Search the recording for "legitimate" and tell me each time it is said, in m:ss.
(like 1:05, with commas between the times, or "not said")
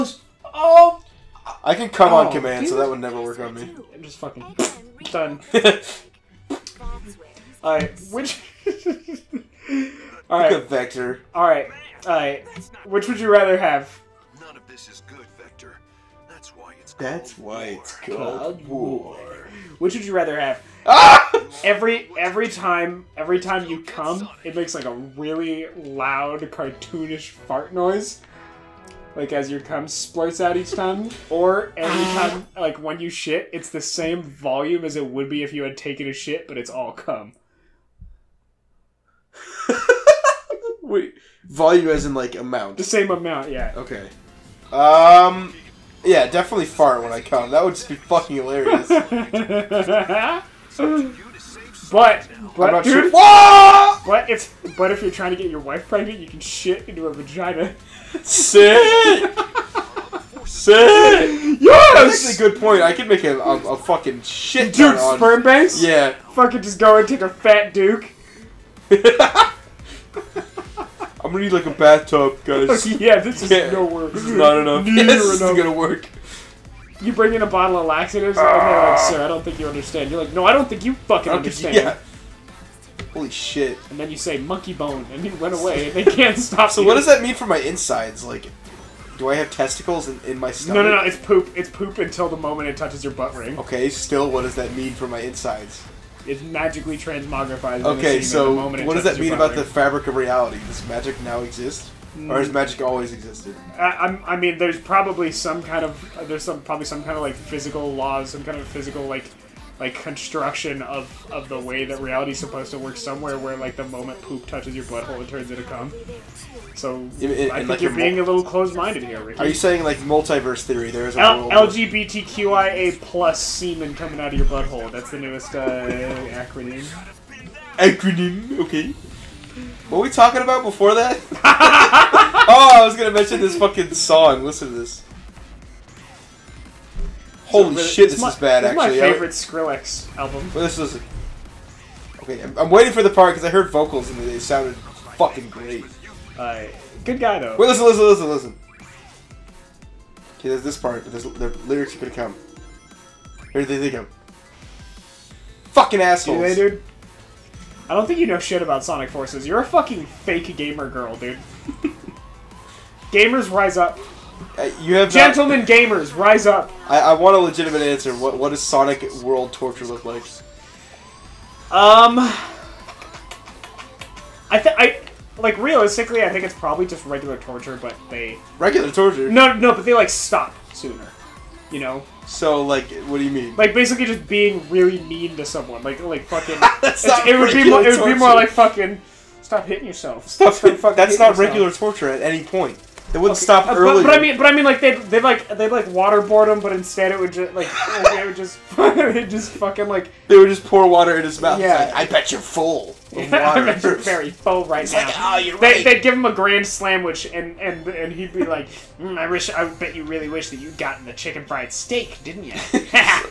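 2:47.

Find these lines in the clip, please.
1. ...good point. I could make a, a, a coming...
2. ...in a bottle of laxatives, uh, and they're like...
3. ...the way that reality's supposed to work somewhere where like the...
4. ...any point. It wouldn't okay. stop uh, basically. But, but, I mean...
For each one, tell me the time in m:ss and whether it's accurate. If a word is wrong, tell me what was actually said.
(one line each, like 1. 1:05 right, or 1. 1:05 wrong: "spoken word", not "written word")
1. 1:02 wrong: "fucking", not "coming"
2. 1:17 right
3. 1:51 right
4. 3:12 wrong: "early", not "basically".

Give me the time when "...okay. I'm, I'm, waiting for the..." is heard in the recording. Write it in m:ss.
2:22.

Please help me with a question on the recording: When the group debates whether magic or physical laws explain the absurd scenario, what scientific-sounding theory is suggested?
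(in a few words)
multiverse theory.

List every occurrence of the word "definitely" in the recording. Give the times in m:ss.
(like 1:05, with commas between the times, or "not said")
0:46.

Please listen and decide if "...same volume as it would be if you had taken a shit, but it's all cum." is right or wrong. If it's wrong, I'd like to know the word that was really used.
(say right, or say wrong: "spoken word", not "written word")
right.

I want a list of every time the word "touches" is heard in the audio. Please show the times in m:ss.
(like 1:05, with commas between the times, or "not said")
1:32, 1:54.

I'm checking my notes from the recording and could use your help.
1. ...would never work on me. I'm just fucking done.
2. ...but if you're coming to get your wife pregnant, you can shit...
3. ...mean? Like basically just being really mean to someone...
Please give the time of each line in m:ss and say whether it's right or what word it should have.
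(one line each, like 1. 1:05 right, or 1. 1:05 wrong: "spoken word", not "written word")
1. 0:02 right
2. 0:54 wrong: "trying", not "coming"
3. 3:03 right.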